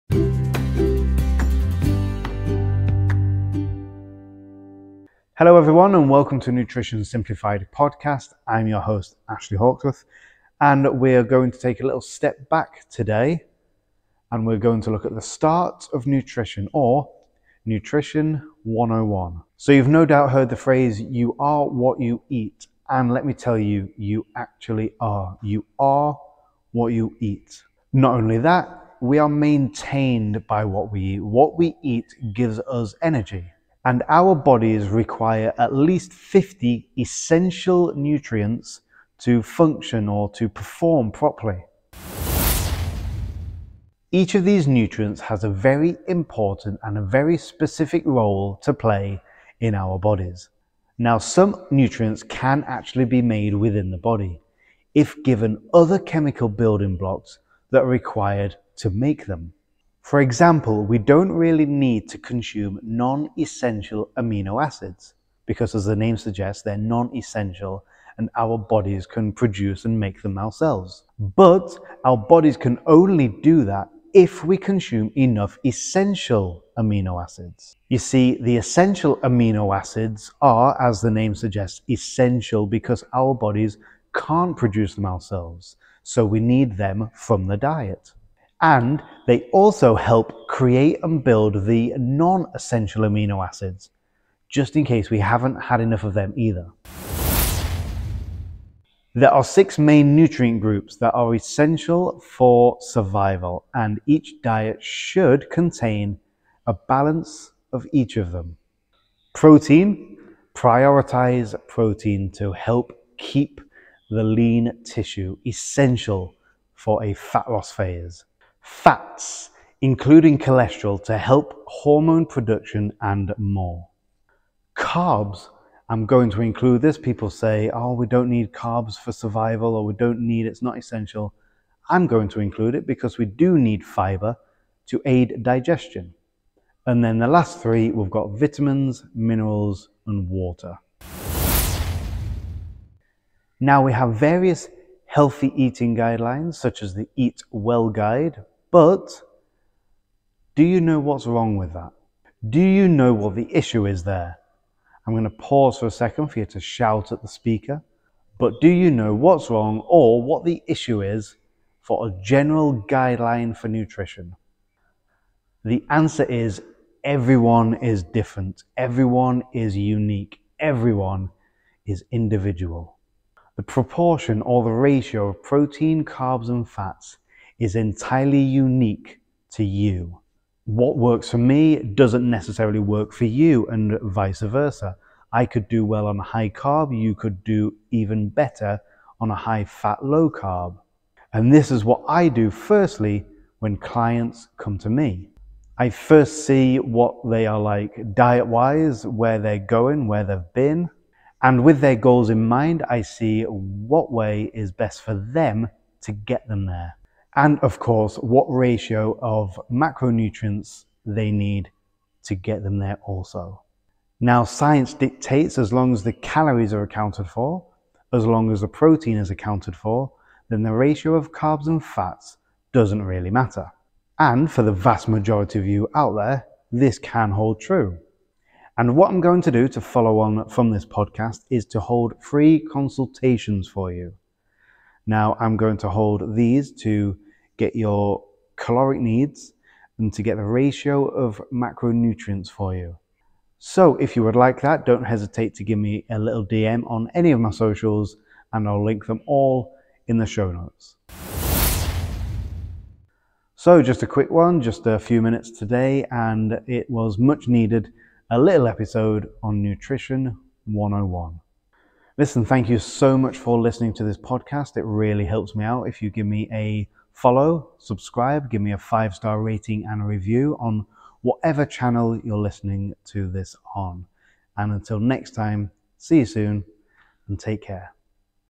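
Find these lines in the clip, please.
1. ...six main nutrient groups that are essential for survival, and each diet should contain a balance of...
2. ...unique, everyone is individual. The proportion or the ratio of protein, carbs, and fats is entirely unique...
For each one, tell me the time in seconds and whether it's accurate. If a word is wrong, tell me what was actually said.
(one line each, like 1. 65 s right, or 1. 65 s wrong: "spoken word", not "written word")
1. 99 s right
2. 169 s right.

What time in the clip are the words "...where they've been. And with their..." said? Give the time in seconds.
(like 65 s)
200 s.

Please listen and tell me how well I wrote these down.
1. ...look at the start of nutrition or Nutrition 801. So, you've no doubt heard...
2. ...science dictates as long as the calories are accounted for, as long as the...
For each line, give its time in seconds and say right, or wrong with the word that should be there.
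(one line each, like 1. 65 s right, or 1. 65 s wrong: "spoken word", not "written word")
1. 14 s wrong: "101", not "801"
2. 214 s right.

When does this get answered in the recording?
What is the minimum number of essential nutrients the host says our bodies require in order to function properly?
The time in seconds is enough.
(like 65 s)
36 s.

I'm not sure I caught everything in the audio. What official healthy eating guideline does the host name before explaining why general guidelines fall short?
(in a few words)
Eat Well Guide.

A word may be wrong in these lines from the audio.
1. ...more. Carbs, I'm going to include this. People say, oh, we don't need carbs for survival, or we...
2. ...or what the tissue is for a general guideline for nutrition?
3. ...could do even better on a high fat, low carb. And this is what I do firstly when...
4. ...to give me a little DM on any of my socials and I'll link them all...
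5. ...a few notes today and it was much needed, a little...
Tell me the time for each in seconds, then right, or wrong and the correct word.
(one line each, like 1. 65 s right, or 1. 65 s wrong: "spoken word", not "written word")
1. 123 s right
2. 159 s wrong: "issue", not "tissue"
3. 187 s right
4. 245 s right
5. 254 s wrong: "minutes", not "notes".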